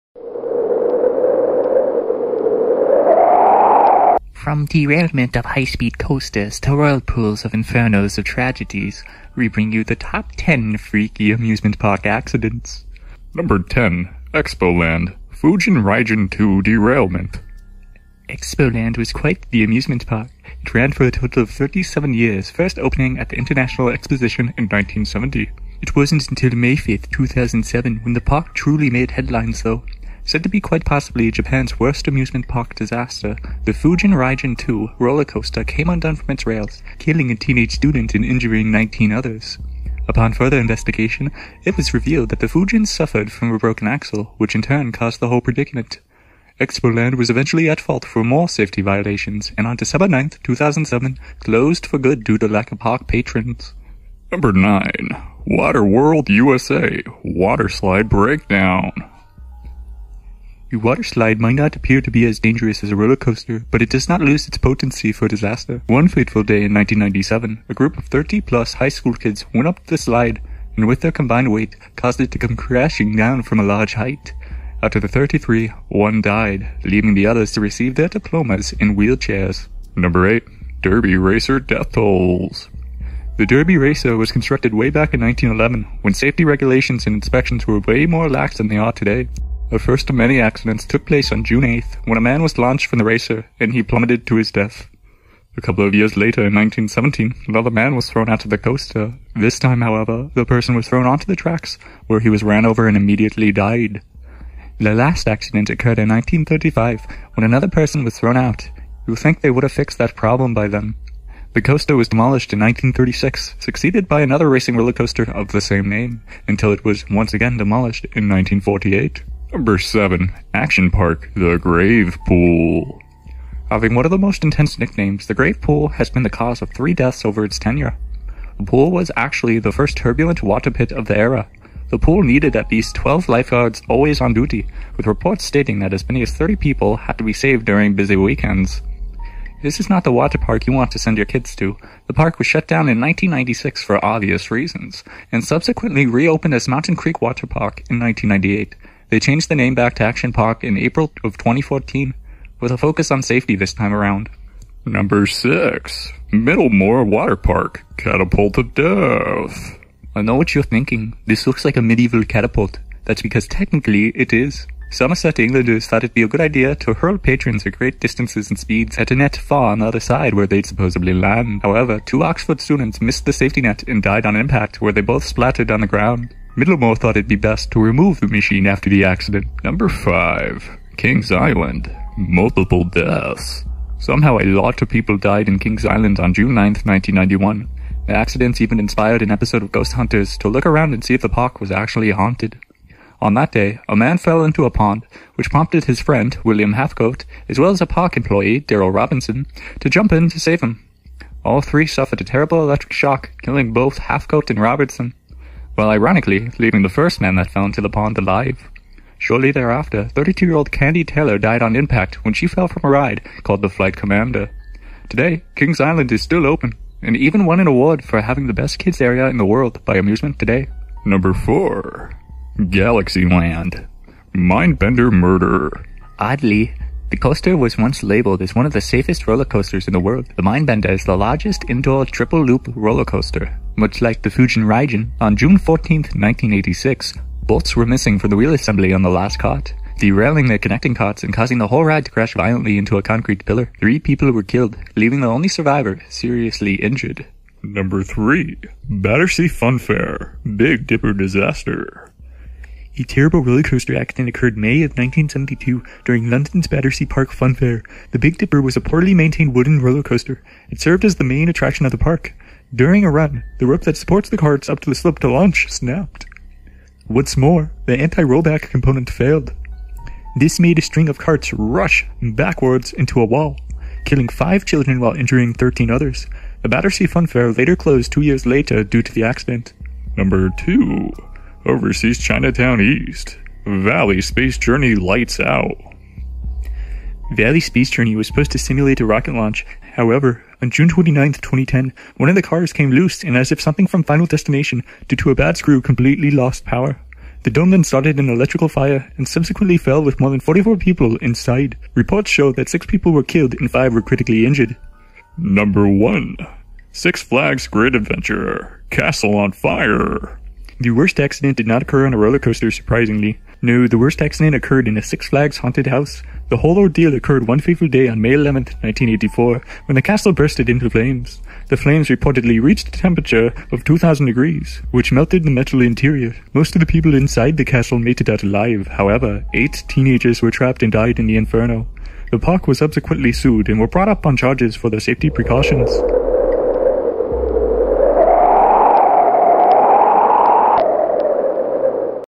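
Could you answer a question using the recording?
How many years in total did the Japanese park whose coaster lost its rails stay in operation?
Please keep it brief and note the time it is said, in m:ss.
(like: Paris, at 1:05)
37, at 0:21.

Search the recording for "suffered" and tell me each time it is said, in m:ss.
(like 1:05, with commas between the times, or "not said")
0:42, 3:21.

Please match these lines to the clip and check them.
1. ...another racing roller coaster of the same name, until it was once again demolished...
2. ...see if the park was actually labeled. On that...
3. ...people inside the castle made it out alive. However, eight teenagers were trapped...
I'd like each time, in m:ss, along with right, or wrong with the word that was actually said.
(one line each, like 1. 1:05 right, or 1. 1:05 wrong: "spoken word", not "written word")
1. 1:54 right
2. 3:11 wrong: "haunted", not "labeled"
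3. 5:26 right.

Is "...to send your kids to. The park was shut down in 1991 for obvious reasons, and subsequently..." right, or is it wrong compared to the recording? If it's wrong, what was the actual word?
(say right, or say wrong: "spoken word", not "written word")
wrong: "1996", not "1991".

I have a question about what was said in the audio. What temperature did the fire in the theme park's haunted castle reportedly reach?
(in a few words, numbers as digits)
2,000 degrees.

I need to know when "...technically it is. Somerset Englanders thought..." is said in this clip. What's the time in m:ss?
2:43.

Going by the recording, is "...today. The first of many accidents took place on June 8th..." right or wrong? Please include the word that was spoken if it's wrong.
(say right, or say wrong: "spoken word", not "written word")
right.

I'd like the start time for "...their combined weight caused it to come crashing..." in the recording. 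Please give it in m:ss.
1:11.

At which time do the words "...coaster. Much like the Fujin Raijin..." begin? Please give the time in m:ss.
3:53.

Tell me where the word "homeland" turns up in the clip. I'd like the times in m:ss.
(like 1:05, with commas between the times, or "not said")
not said.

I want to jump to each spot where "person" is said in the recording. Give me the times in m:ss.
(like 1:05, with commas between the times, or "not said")
1:40, 1:47.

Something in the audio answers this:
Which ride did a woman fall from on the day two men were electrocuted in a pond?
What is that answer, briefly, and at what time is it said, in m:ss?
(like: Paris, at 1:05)
Flight Commander, at 3:33.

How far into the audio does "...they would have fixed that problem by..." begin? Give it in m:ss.
1:49.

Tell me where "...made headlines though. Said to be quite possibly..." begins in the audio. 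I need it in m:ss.
0:28.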